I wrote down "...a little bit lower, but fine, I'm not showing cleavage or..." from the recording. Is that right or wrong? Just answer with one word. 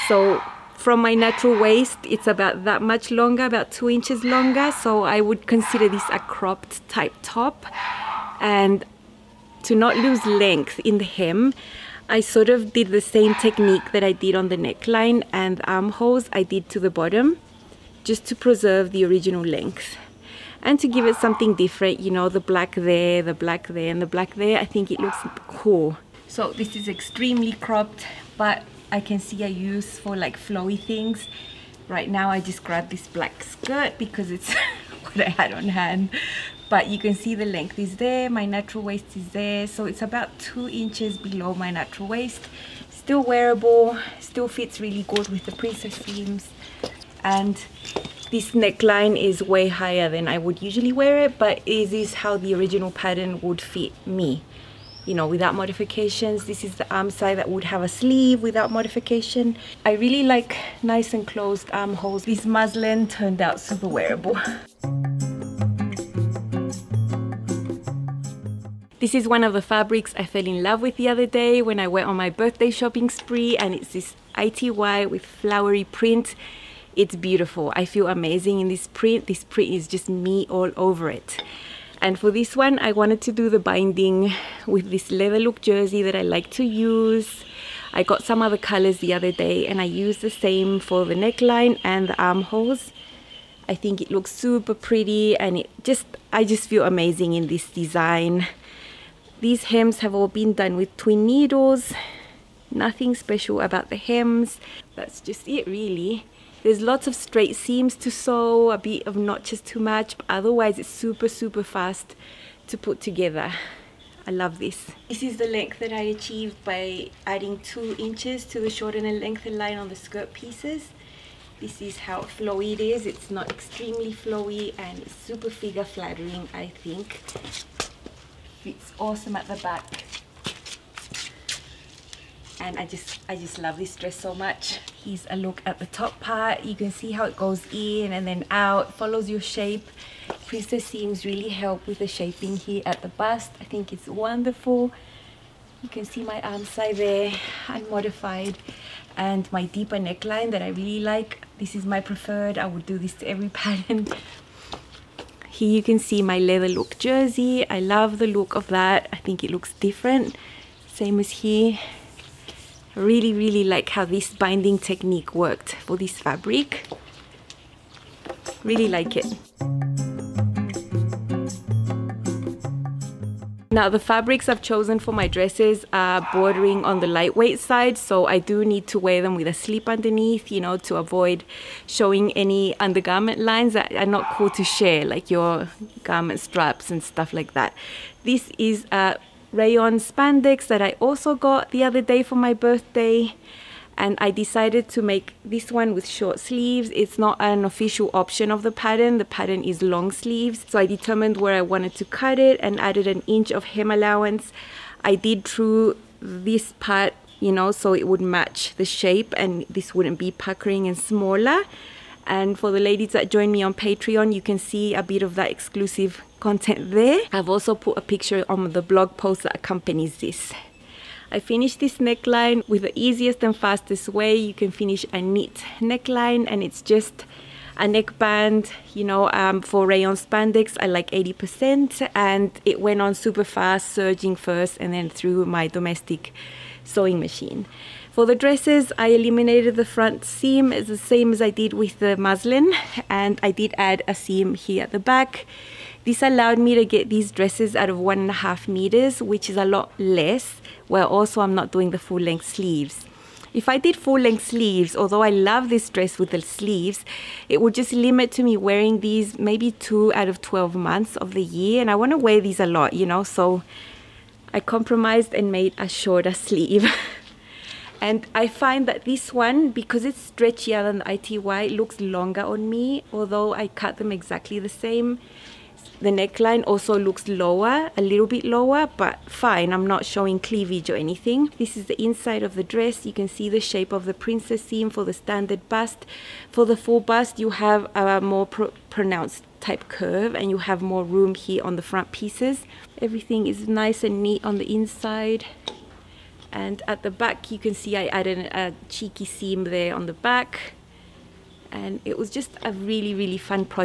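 right.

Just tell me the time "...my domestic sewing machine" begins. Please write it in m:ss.
3:55.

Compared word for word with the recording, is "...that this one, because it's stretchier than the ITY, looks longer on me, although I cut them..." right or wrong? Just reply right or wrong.
right.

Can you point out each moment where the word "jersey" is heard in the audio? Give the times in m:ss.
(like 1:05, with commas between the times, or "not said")
1:25, 2:36.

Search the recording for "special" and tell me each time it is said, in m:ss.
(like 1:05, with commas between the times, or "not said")
1:43.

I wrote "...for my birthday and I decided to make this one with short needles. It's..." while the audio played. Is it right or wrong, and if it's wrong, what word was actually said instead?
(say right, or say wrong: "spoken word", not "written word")
wrong: "sleeves", not "needles".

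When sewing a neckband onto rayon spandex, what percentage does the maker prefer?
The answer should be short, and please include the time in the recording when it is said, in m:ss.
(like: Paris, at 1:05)
80%, at 3:51.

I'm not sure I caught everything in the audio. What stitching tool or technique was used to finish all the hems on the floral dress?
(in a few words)
twin needles.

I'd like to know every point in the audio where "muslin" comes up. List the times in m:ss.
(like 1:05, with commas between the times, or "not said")
1:02, 4:02.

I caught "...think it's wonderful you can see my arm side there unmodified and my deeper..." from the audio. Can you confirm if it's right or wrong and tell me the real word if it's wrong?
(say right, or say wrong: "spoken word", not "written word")
right.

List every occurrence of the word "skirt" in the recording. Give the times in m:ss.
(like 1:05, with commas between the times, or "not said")
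0:33, 1:59.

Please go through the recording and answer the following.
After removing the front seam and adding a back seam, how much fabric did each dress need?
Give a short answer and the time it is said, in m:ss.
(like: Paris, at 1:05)
1.5 meters, at 4:07.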